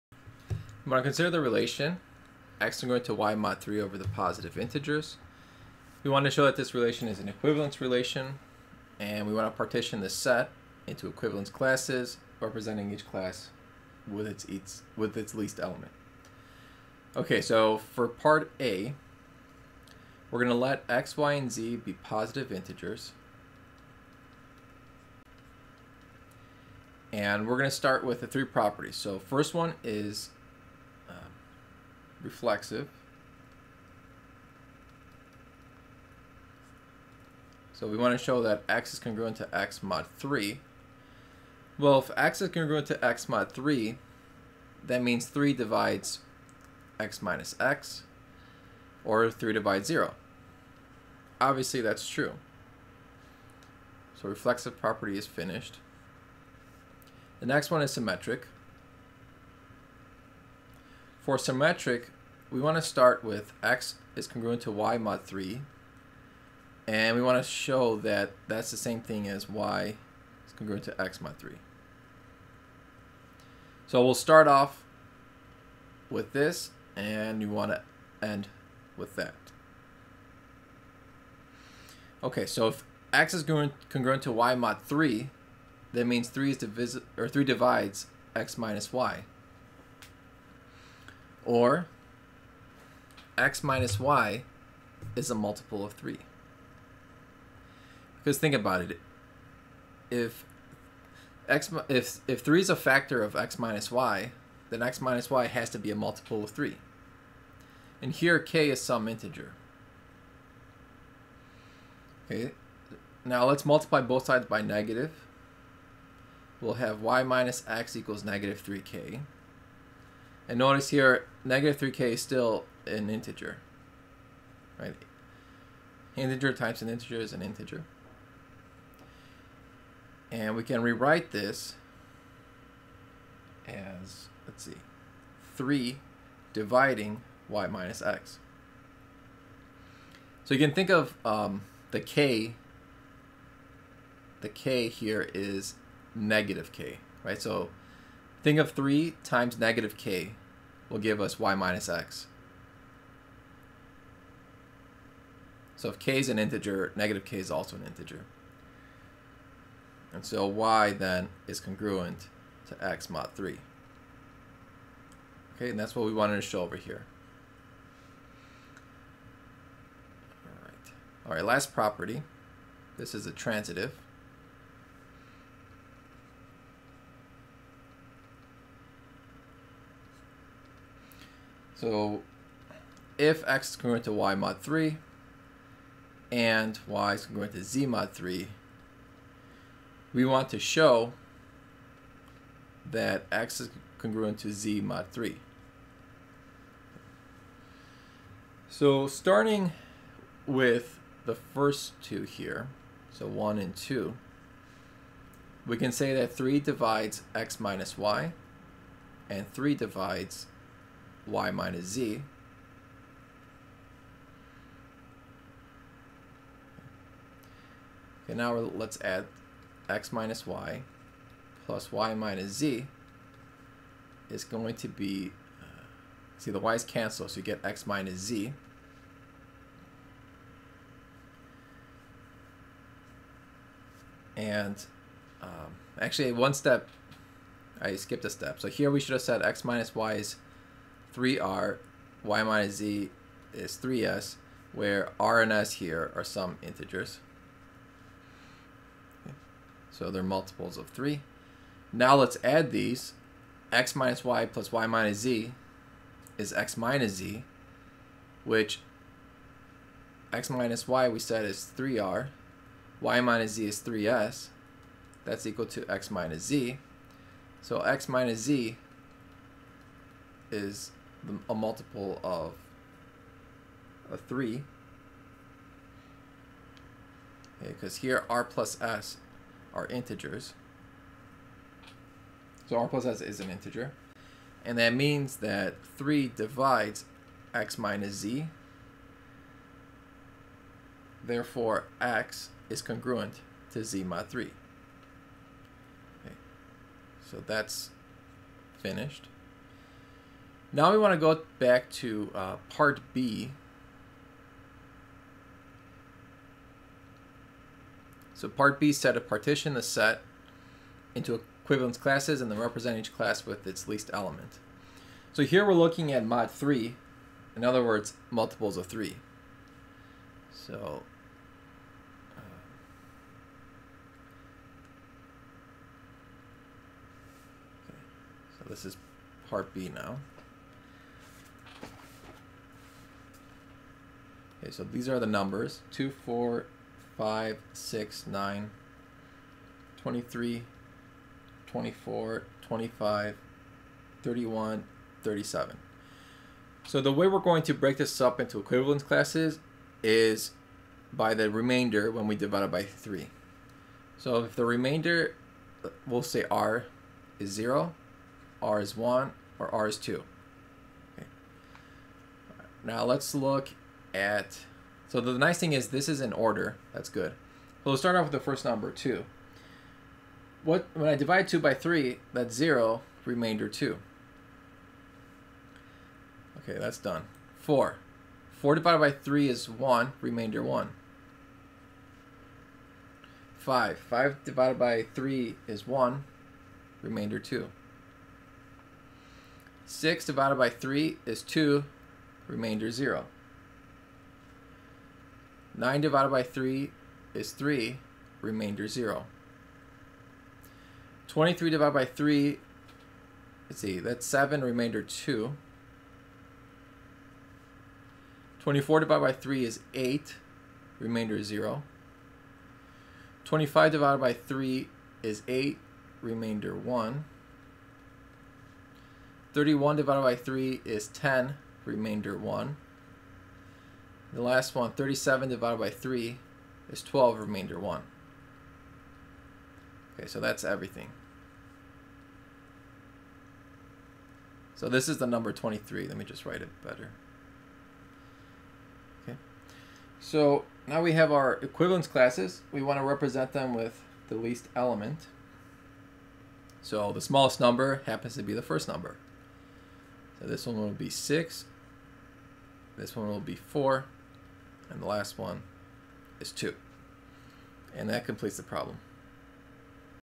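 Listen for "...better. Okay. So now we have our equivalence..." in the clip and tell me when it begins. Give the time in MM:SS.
07:16.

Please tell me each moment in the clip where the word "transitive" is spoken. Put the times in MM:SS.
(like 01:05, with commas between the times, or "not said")
02:53.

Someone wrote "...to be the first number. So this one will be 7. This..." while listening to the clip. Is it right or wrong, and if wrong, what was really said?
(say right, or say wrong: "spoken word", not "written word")
wrong: "6", not "7".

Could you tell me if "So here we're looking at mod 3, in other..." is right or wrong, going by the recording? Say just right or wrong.
right.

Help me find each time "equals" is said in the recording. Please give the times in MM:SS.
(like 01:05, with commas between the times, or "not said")
01:57, 04:25.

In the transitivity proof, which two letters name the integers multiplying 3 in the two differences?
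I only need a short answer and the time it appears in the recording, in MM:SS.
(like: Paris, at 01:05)
r and s, at 04:05.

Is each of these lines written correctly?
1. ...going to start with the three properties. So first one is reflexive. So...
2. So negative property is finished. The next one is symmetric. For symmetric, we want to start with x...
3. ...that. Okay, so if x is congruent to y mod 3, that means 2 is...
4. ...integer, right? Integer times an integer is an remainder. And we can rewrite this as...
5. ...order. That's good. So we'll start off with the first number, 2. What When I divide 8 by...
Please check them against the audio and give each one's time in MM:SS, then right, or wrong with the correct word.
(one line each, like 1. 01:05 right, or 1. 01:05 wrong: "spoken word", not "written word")
1. 00:27 right
2. 00:54 wrong: "reflexive", not "negative"
3. 01:19 wrong: "3", not "2"
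4. 02:03 wrong: "integer", not "remainder"
5. 06:06 wrong: "2", not "8".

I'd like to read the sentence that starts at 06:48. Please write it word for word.
24 divided by 3 is 8, remainder 0.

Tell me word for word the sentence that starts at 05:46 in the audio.
So the way we're going to break this up into equivalence classes is by the remainder when we divide it by 3.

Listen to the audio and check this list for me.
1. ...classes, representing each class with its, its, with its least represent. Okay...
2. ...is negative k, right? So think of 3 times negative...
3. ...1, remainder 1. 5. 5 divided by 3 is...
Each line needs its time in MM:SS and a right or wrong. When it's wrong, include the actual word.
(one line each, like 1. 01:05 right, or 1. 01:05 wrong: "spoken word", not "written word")
1. 00:11 wrong: "element", not "represent"
2. 02:25 right
3. 06:19 right.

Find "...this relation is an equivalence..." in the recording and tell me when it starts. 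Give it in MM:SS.
00:06.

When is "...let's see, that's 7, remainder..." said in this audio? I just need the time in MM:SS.
06:43.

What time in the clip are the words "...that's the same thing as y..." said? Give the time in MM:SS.
01:08.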